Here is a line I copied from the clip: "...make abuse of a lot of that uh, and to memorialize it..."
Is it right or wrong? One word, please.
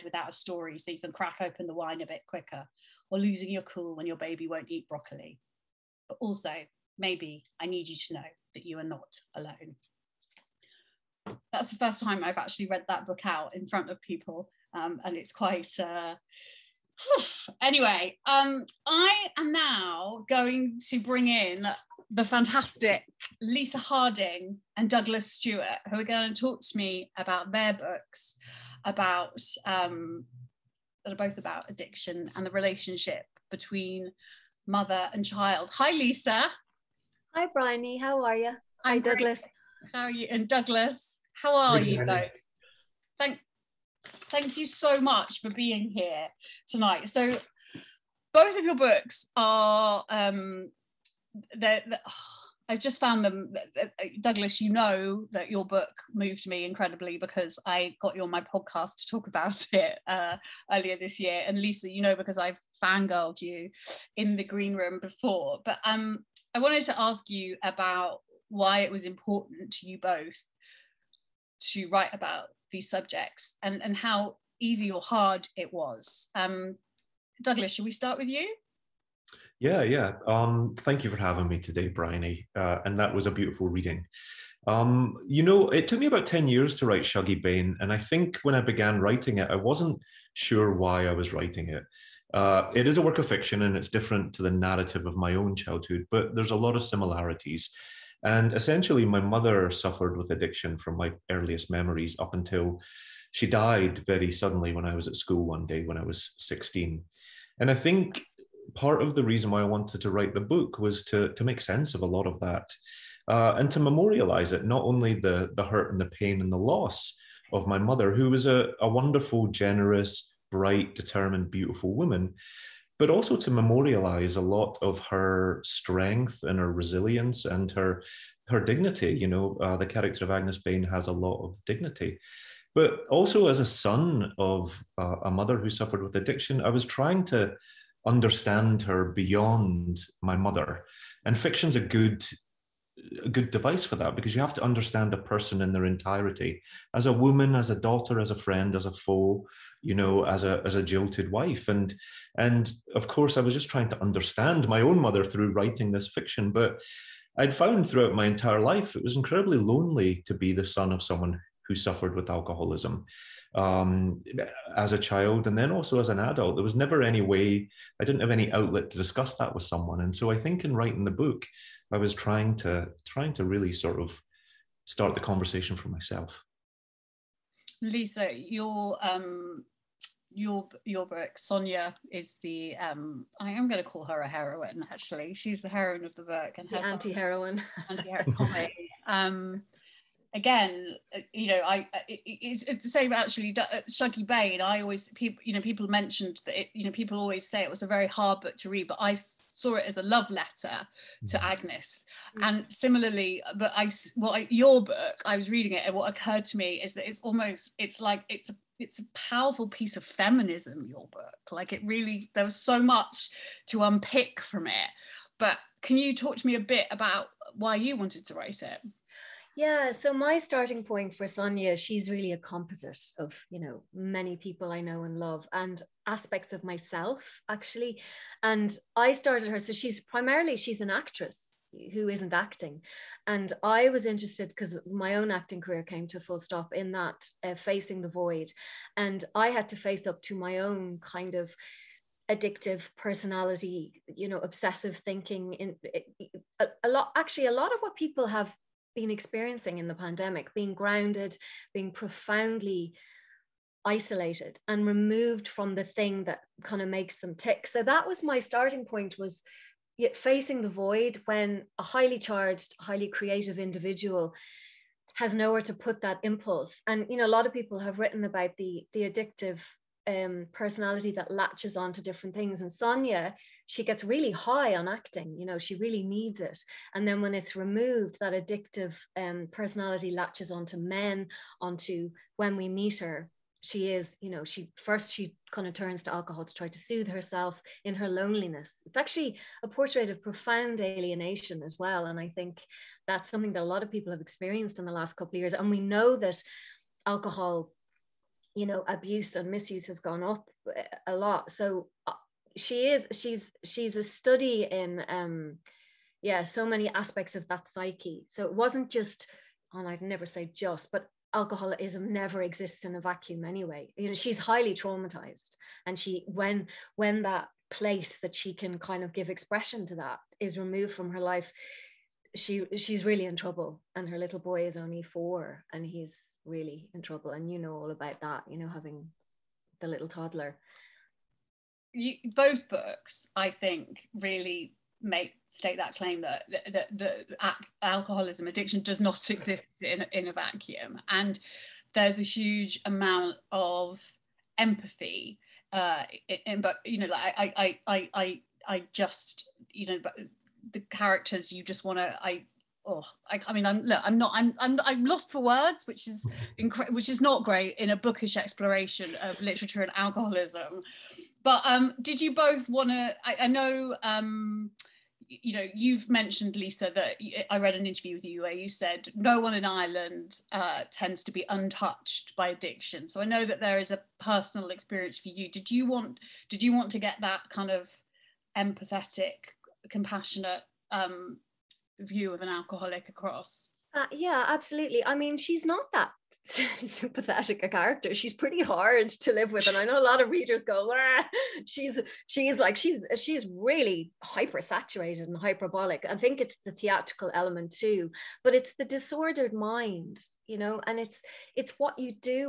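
wrong.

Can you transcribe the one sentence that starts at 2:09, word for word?
You know, uh, the character of Agnes Bain has a lot of dignity.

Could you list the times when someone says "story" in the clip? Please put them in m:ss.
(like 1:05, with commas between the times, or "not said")
0:00.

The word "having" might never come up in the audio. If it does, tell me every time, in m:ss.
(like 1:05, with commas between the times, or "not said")
1:21, 5:28.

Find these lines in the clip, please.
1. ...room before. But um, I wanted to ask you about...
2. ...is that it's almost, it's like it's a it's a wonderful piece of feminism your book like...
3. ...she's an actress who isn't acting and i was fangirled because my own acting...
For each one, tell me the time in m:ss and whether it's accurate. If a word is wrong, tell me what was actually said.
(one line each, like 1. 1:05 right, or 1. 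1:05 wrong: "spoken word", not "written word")
1. 1:04 right
2. 3:26 wrong: "powerful", not "wonderful"
3. 3:50 wrong: "interested", not "fangirled".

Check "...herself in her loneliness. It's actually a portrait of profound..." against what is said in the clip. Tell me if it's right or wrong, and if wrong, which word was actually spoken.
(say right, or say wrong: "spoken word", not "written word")
right.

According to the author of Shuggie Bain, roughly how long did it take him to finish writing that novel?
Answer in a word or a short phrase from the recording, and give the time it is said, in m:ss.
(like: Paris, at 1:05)
10 years, at 1:26.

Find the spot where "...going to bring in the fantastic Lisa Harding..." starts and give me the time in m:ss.
0:20.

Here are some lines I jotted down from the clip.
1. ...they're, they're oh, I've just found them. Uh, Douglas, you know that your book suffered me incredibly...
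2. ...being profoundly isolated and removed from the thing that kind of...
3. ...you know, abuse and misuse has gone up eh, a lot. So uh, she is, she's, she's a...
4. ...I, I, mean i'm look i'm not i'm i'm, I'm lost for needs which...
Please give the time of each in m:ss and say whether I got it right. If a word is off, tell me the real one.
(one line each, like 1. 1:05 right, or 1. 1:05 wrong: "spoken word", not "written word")
1. 0:51 wrong: "moved", not "suffered"
2. 4:11 right
3. 4:58 right
4. 5:53 wrong: "words", not "needs".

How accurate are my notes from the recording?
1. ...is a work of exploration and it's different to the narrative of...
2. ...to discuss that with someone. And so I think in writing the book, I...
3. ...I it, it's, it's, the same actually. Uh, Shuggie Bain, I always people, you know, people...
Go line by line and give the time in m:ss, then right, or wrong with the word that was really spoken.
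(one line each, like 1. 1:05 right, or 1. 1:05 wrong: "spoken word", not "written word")
1. 1:32 wrong: "fiction", not "exploration"
2. 2:48 right
3. 3:11 right.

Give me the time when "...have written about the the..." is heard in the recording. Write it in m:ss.
4:27.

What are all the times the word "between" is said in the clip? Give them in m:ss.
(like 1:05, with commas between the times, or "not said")
0:33.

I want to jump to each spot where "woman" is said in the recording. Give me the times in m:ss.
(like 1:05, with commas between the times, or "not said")
2:01, 2:27.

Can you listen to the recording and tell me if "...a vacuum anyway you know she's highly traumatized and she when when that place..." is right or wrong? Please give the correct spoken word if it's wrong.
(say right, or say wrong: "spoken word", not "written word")
right.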